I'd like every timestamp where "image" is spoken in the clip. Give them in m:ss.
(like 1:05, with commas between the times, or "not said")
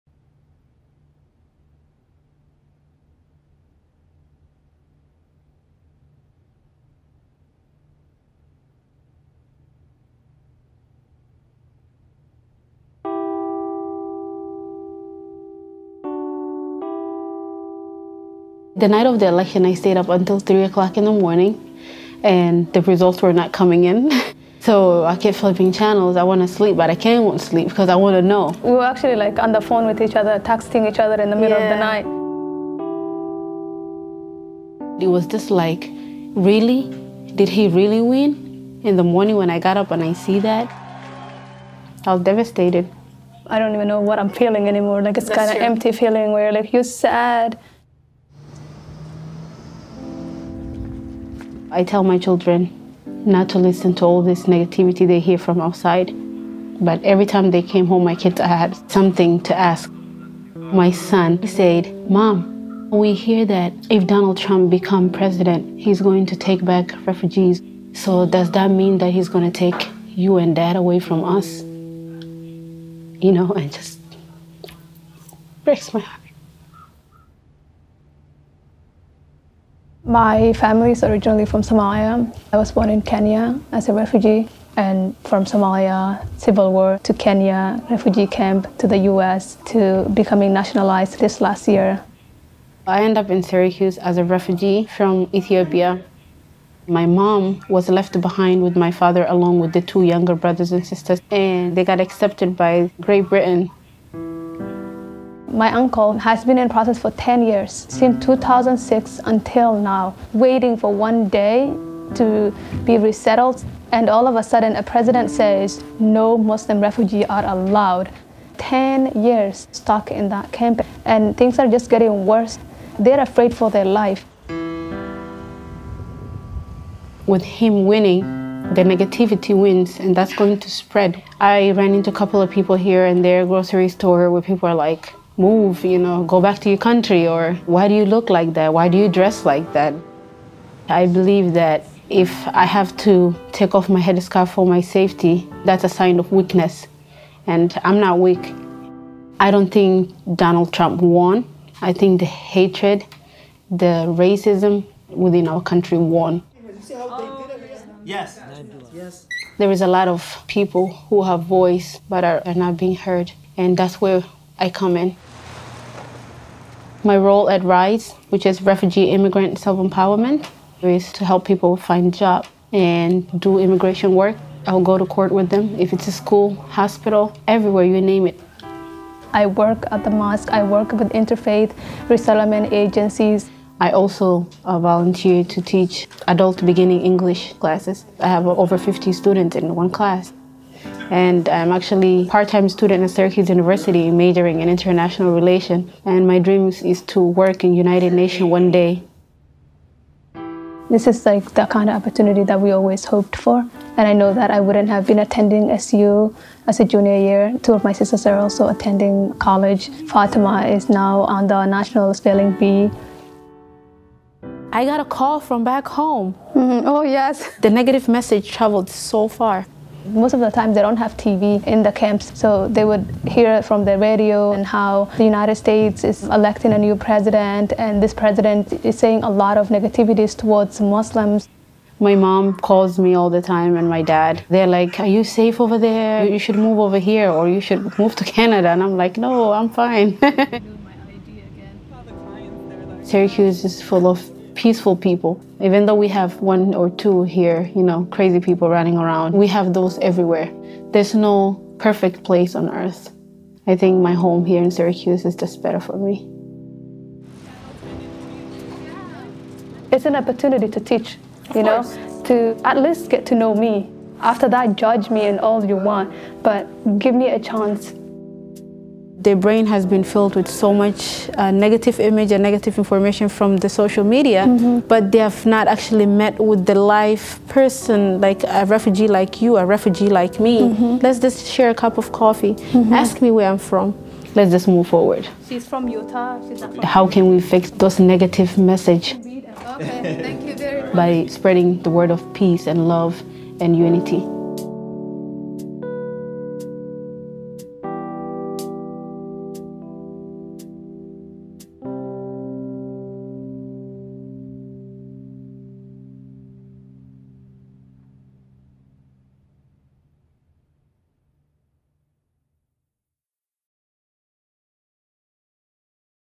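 4:31.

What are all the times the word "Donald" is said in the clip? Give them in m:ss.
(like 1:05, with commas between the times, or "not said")
1:04, 2:30.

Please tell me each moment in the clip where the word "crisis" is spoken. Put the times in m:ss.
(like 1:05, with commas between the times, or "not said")
not said.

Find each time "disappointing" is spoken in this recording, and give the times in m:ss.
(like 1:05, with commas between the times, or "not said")
not said.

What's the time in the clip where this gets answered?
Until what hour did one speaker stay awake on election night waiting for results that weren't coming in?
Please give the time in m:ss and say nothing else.
0:20.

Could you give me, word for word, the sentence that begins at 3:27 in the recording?
Two of my sisters are also attending college.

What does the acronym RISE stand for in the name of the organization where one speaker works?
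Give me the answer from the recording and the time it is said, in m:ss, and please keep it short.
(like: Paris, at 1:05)
Refugee Immigrant Self Empowerment, at 2:48.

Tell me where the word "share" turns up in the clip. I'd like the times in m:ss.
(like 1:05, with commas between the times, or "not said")
4:41.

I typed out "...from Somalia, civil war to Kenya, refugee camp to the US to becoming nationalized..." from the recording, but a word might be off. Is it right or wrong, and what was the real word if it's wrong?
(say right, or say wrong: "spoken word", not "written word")
right.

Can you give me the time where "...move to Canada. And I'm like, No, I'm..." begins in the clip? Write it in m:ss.
3:57.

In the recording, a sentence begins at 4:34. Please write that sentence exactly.
but they have not actually met with the live person, like a refugee like you, a refugee like me.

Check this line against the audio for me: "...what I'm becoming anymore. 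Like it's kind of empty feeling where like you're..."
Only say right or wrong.
wrong.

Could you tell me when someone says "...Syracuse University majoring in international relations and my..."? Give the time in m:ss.
3:13.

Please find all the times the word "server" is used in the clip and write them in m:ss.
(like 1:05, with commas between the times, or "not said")
not said.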